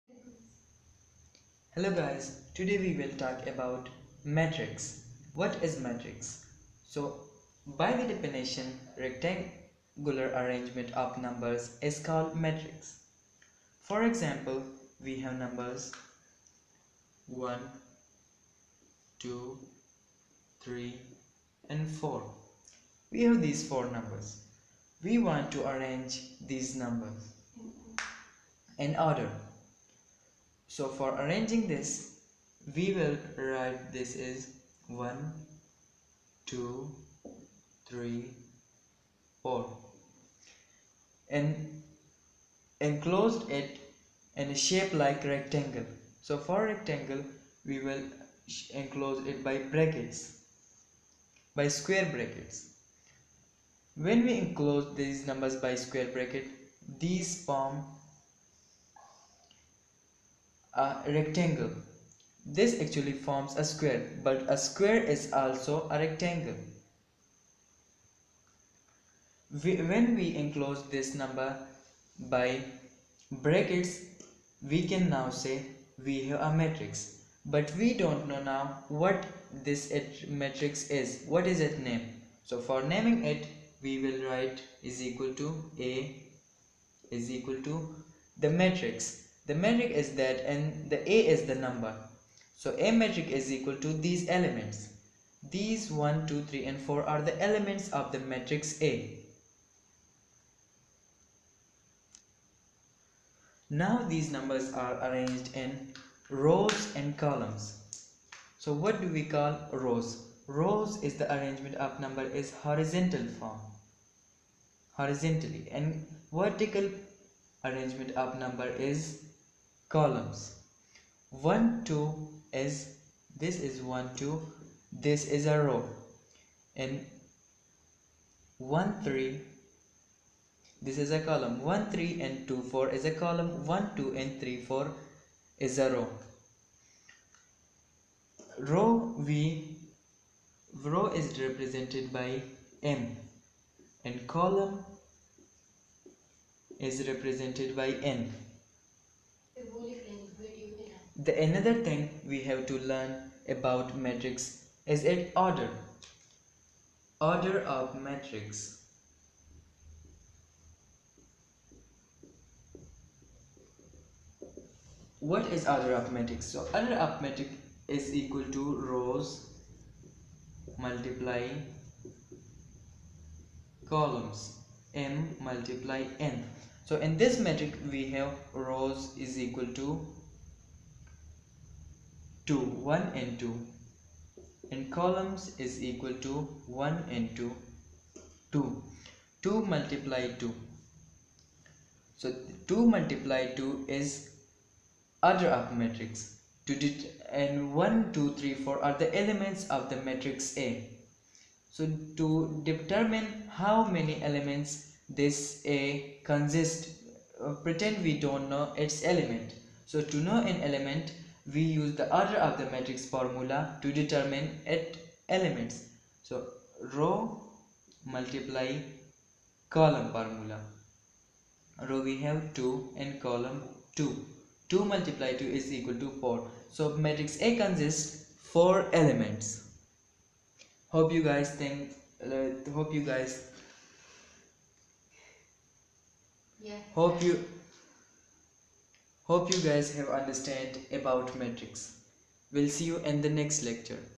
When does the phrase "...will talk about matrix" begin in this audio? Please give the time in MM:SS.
00:03.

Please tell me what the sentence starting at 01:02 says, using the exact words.
This actually forms a square, but a square is also a rectangle.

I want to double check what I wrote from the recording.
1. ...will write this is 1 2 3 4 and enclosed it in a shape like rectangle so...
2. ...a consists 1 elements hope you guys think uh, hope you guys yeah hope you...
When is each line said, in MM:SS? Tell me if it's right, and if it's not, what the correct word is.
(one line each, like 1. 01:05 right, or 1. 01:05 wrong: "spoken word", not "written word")
1. 00:32 right
2. 03:47 wrong: "4", not "1".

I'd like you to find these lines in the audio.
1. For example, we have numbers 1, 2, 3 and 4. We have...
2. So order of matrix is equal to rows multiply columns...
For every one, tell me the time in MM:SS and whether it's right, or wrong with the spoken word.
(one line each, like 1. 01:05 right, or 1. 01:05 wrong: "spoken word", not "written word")
1. 00:13 right
2. 02:46 right.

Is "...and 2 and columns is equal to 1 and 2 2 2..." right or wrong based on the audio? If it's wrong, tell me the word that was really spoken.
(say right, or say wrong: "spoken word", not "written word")
right.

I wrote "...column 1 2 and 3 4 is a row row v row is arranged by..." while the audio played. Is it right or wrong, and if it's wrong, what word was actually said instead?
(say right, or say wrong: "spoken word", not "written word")
wrong: "represented", not "arranged".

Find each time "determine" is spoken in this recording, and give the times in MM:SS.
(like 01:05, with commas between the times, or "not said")
03:22, 03:33.